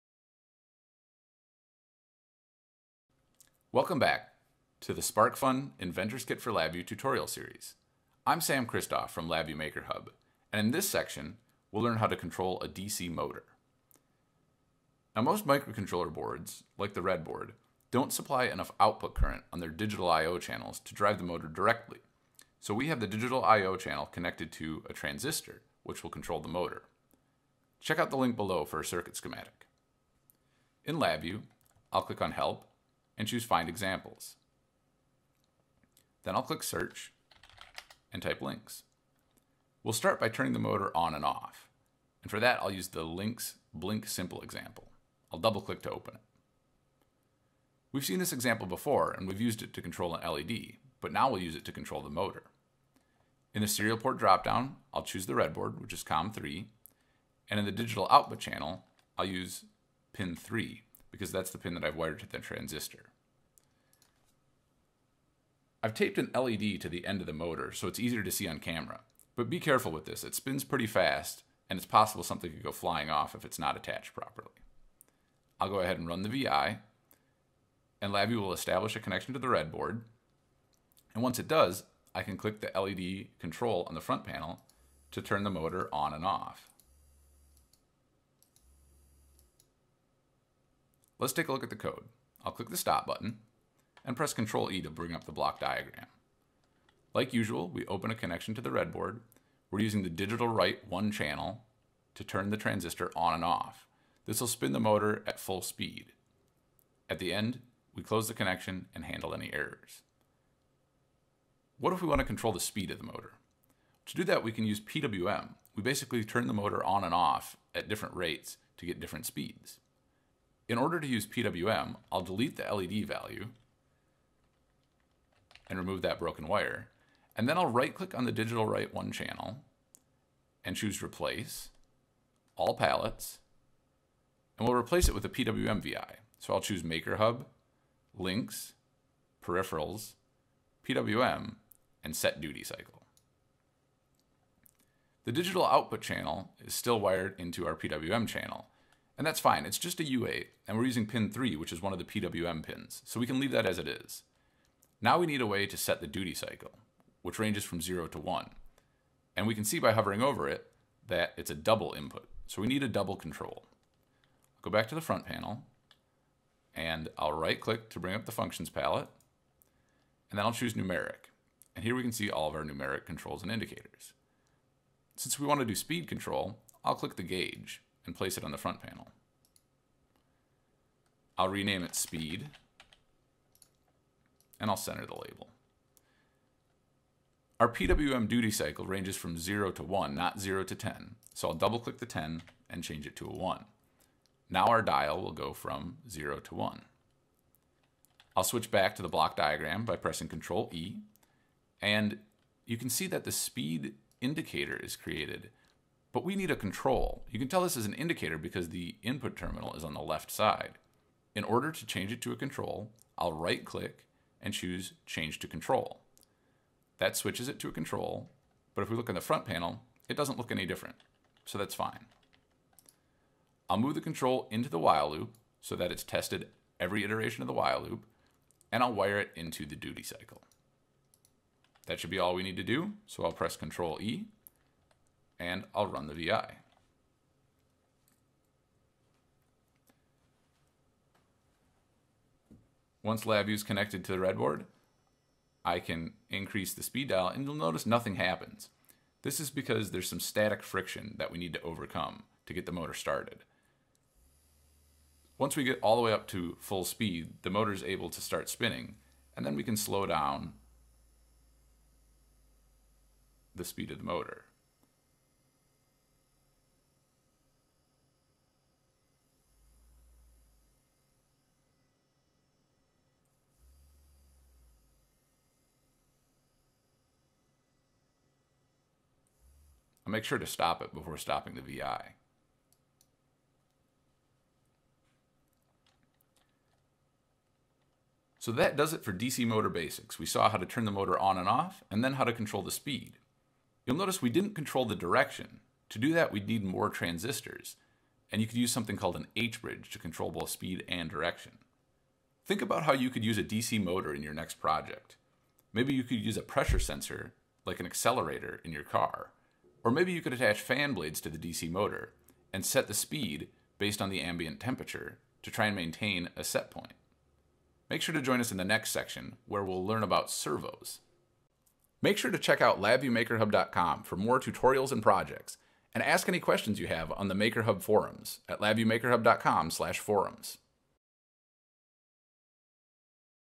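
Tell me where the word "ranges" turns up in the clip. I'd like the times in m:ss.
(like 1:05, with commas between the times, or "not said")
2:37, 3:08.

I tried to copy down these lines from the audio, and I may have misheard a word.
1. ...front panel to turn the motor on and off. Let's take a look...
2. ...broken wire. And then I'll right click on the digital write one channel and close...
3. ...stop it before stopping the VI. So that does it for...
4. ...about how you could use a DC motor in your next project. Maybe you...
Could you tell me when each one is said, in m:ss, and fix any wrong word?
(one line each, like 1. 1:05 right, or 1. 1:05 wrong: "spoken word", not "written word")
1. 1:24 right
2. 2:06 wrong: "choose", not "close"
3. 4:40 right
4. 5:02 right.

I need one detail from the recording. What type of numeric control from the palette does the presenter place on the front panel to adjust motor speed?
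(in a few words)
Gauge.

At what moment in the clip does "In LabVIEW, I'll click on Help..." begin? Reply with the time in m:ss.
0:30.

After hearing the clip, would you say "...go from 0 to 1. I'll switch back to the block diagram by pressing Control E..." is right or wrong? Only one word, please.
right.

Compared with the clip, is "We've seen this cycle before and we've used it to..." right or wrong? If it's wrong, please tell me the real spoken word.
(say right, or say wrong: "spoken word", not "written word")
wrong: "example", not "cycle".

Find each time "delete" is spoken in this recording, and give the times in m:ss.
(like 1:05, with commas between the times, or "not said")
2:02.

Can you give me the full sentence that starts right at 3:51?
That should be all we need to do, so I'll press Control E, and I'll run the VI.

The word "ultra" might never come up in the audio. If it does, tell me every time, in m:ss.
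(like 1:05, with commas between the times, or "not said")
not said.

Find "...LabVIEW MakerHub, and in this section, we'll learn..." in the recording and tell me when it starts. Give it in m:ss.
0:09.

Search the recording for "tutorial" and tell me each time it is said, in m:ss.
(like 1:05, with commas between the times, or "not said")
0:06, 5:24.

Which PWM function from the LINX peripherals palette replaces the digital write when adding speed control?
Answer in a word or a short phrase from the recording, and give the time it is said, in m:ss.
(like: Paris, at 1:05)
Set duty cycle, at 2:22.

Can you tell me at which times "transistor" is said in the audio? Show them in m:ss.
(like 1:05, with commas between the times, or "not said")
0:24, 1:02, 1:42, 4:56.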